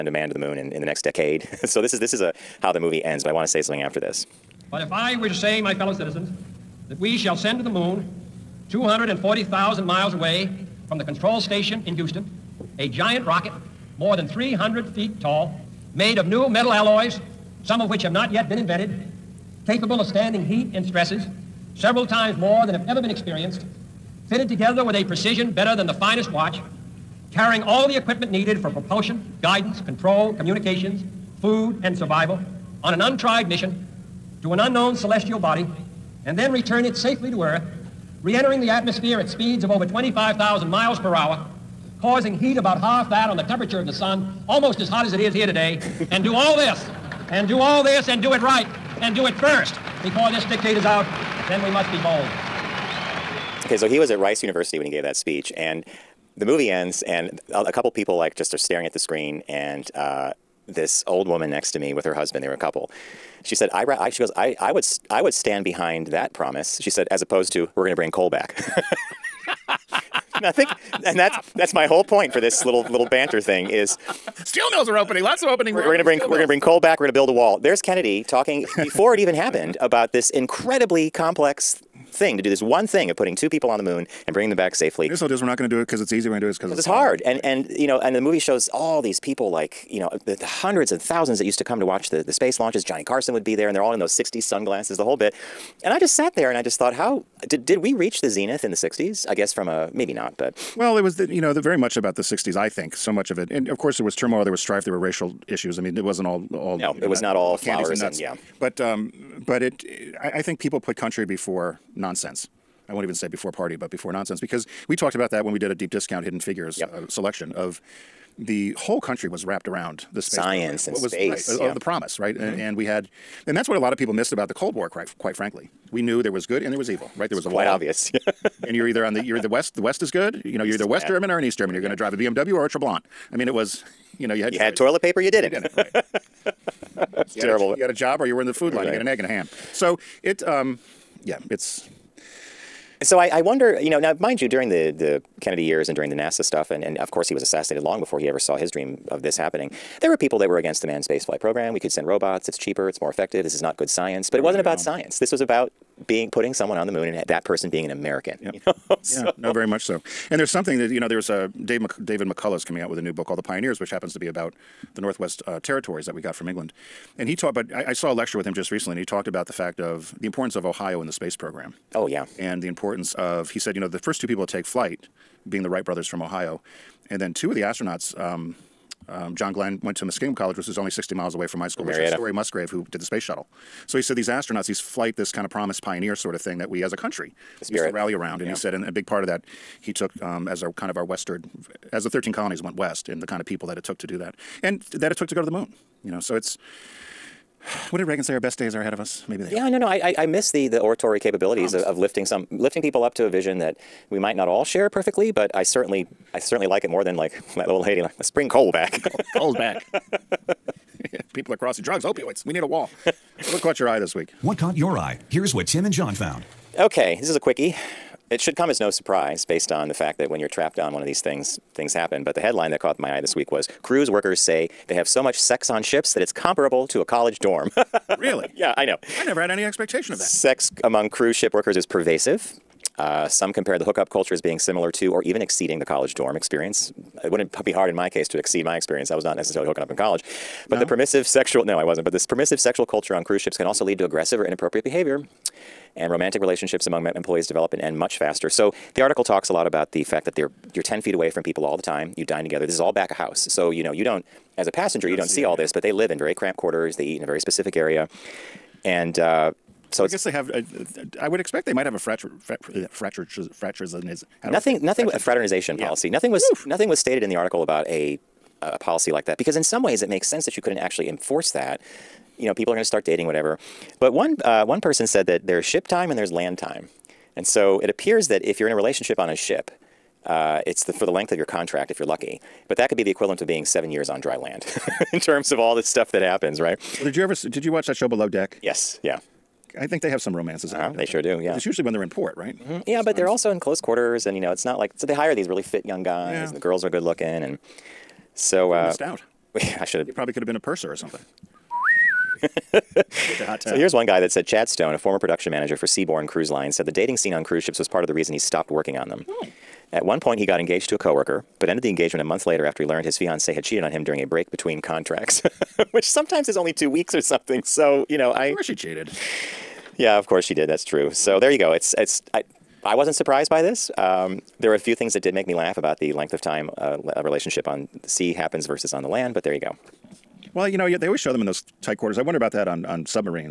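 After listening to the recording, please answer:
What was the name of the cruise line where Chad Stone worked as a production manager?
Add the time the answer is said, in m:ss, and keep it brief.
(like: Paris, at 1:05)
Seabourn, at 5:05.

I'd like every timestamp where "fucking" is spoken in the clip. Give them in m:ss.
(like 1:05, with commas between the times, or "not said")
not said.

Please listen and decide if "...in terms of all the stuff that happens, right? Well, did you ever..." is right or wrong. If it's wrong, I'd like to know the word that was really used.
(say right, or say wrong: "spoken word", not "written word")
right.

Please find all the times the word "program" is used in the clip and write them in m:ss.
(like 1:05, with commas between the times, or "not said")
2:00, 2:31, 2:51.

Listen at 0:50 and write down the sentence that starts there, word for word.
Before this is out, then we must be bold.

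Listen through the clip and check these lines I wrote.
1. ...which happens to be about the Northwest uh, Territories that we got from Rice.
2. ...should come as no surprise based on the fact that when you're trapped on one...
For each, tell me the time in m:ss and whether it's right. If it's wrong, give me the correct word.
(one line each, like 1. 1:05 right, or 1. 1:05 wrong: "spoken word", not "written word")
1. 2:43 wrong: "England", not "Rice"
2. 3:38 right.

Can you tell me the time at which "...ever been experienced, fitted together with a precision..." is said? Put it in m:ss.
0:22.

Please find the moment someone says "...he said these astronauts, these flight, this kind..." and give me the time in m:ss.
3:03.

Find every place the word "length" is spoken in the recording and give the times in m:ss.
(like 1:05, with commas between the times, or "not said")
4:41, 5:26.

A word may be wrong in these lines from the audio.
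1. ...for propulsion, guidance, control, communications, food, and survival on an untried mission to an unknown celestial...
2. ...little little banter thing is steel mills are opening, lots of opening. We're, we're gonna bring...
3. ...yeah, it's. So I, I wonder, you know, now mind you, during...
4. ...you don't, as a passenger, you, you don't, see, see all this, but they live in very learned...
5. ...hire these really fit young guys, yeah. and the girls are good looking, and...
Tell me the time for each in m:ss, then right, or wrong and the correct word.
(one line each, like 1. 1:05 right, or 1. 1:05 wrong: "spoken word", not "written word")
1. 0:28 right
2. 1:12 right
3. 2:21 right
4. 4:13 wrong: "cramped", not "learned"
5. 4:55 right.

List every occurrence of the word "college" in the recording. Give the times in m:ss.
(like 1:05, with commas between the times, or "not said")
3:00, 3:47, 3:55, 3:59.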